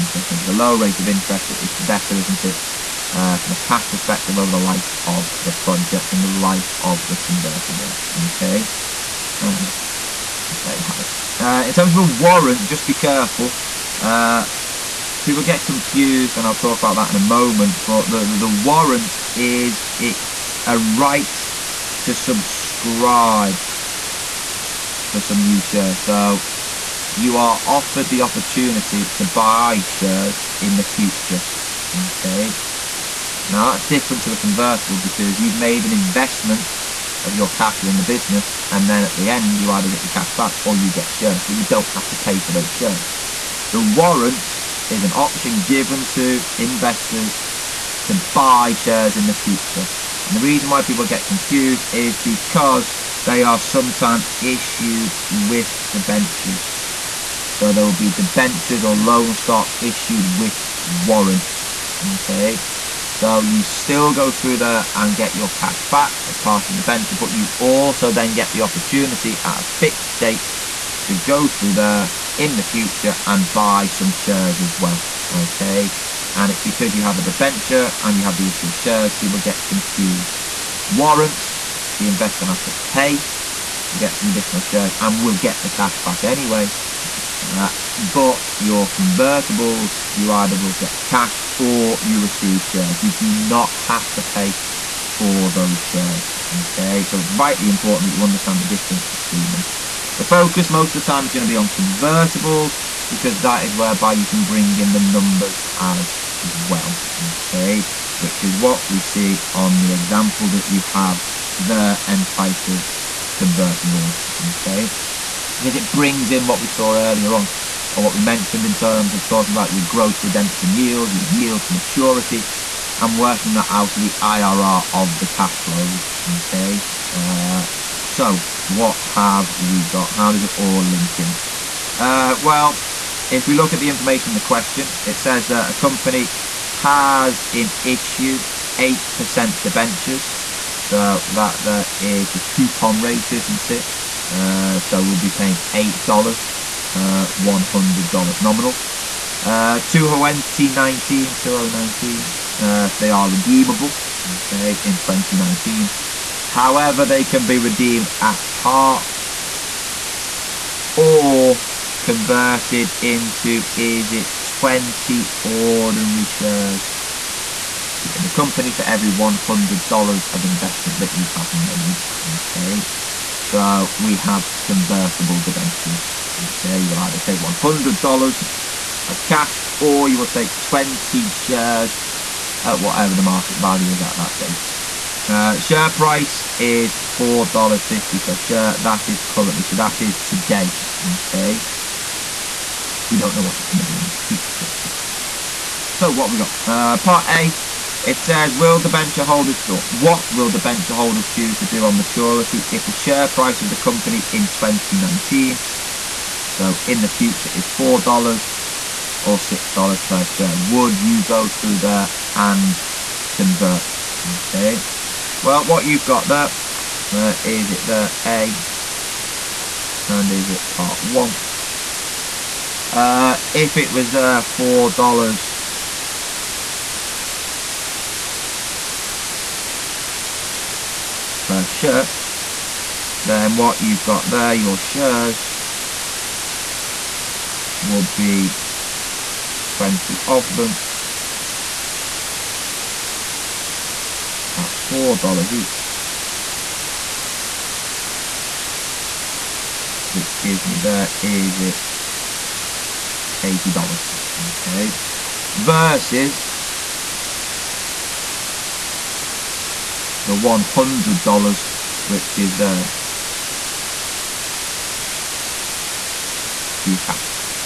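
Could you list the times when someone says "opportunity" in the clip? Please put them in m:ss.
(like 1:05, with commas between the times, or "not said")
0:28, 1:08.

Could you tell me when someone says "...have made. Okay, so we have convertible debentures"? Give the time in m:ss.
2:51.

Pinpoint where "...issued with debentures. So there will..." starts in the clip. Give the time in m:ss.
0:54.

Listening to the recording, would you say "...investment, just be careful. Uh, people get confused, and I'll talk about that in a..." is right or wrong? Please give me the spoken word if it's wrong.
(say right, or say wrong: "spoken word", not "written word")
wrong: "warrant", not "investment".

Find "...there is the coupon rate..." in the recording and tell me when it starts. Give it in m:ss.
2:21.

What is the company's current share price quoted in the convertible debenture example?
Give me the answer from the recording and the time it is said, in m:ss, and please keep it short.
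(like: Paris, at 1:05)
$4.50, at 3:06.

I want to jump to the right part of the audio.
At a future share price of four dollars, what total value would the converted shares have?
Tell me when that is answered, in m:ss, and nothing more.
4:13.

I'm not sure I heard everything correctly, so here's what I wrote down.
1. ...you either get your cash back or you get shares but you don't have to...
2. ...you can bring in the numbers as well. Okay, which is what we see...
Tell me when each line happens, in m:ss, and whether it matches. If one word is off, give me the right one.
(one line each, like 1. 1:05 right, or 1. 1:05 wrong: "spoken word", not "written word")
1. 0:39 right
2. 1:44 right.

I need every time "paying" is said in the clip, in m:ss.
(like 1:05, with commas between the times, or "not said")
2:25.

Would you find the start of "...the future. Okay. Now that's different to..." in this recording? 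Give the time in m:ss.
0:30.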